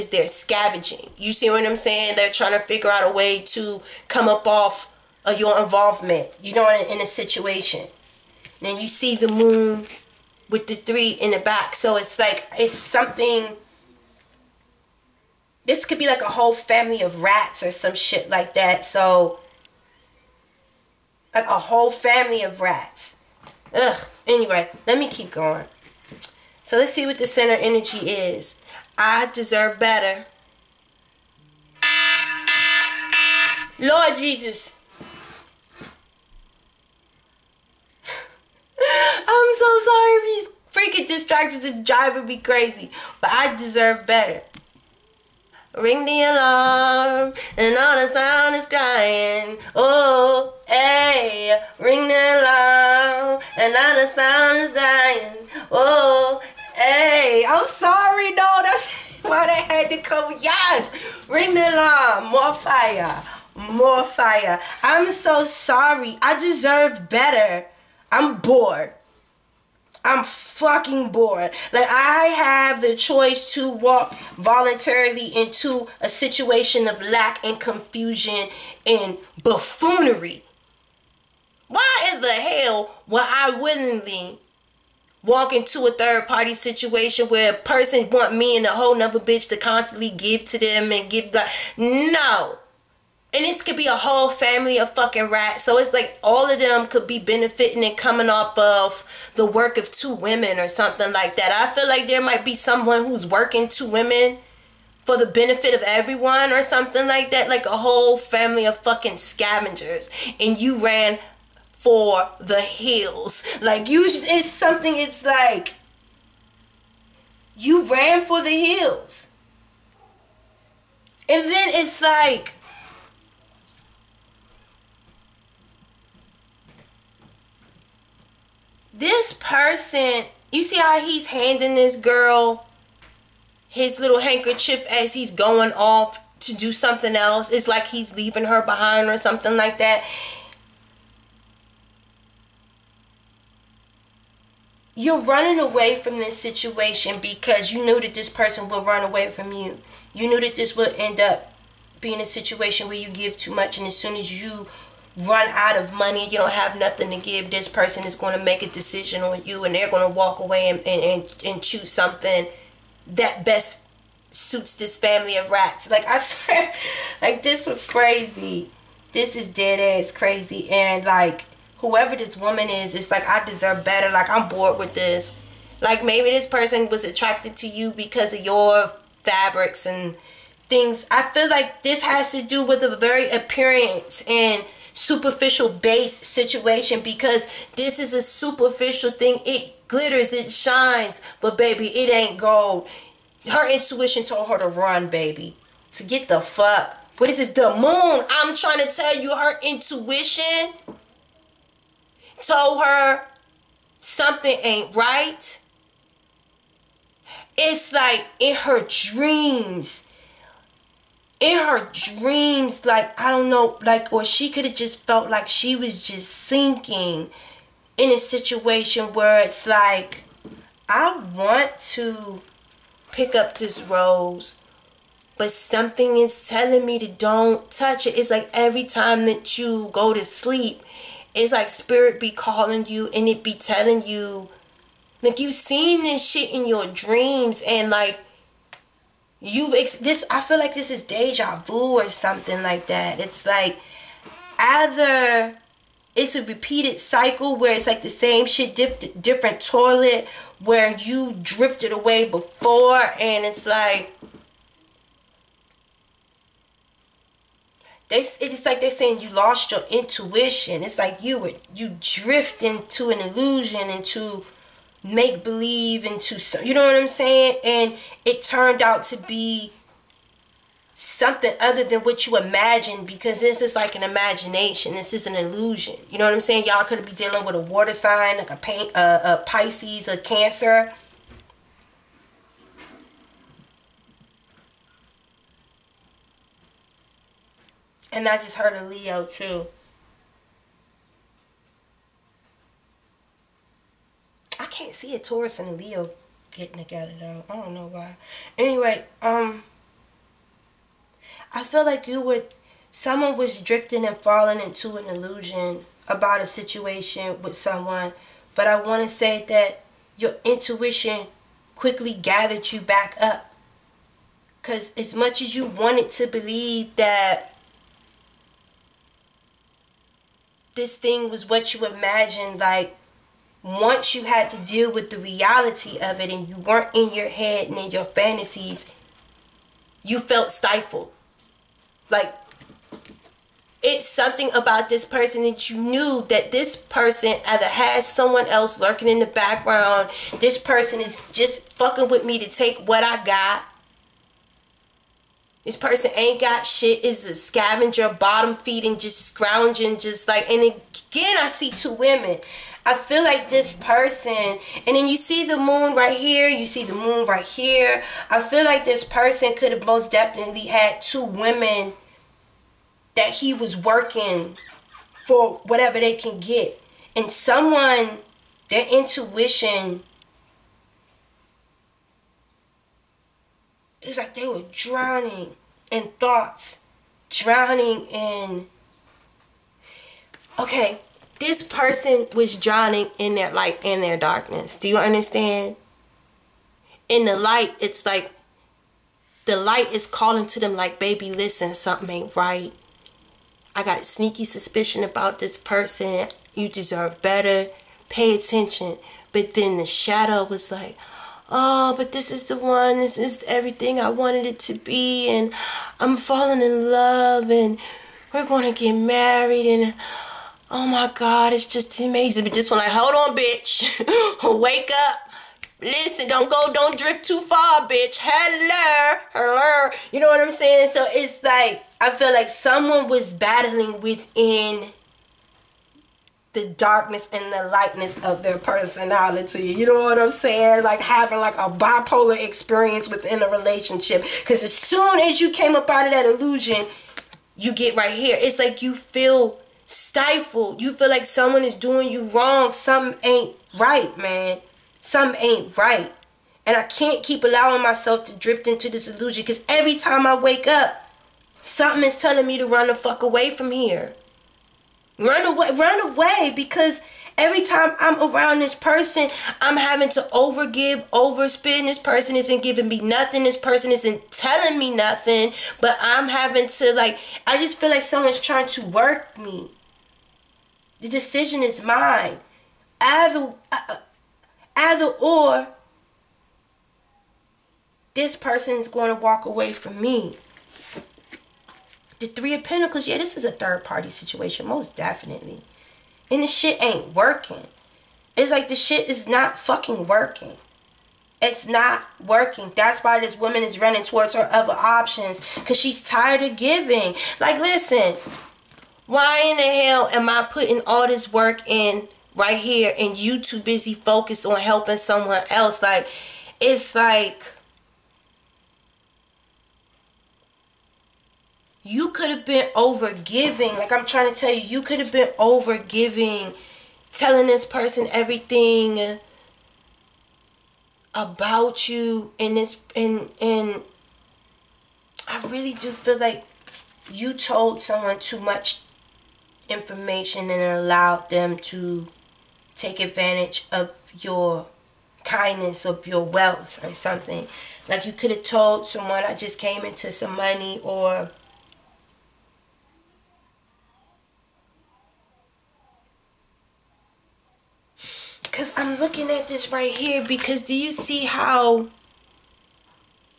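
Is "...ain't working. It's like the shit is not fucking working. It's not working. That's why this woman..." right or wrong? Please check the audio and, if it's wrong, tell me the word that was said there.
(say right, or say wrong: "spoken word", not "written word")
right.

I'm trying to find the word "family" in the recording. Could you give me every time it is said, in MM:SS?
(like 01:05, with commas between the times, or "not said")
00:16, 00:21, 01:34, 01:48, 02:44.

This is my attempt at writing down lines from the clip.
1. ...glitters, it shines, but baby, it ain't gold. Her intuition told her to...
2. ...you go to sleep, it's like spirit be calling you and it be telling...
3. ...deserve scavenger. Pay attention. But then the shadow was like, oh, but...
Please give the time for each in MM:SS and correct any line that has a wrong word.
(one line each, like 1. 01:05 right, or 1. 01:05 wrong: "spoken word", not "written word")
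1. 03:09 right
2. 03:49 right
3. 06:36 wrong: "better", not "scavenger".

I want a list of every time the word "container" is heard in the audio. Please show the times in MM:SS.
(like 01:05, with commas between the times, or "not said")
not said.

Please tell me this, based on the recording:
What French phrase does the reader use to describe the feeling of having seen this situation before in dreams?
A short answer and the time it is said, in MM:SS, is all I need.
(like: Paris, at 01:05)
Deja vu, at 04:01.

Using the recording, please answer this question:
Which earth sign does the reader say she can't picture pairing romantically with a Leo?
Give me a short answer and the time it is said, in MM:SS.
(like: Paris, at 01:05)
Taurus, at 04:54.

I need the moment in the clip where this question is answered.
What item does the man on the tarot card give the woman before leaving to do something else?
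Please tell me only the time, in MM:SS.
02:13.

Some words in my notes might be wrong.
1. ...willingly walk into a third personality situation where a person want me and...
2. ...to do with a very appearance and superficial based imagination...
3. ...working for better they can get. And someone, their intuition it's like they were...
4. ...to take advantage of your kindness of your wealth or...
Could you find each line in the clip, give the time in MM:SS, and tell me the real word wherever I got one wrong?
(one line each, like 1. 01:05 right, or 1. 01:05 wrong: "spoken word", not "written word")
1. 01:23 wrong: "party", not "personality"
2. 03:02 wrong: "situation", not "imagination"
3. 06:03 wrong: "whatever", not "better"
4. 08:51 right.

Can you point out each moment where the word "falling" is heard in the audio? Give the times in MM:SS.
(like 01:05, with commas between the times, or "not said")
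05:04, 06:46.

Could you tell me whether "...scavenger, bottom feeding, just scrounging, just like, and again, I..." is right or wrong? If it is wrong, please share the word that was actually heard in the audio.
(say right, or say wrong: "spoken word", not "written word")
right.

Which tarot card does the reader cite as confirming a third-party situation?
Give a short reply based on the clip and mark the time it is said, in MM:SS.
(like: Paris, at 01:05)
Three of Pentacles, at 08:02.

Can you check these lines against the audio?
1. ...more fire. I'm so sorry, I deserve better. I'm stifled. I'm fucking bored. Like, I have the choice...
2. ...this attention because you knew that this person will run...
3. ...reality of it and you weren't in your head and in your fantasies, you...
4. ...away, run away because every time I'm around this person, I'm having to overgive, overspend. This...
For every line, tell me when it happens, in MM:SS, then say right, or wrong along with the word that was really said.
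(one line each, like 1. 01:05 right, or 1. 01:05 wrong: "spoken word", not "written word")
1. 01:03 wrong: "bored", not "stifled"
2. 02:26 wrong: "situation", not "attention"
3. 05:25 right
4. 07:35 right.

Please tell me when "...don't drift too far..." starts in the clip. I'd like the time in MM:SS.
06:56.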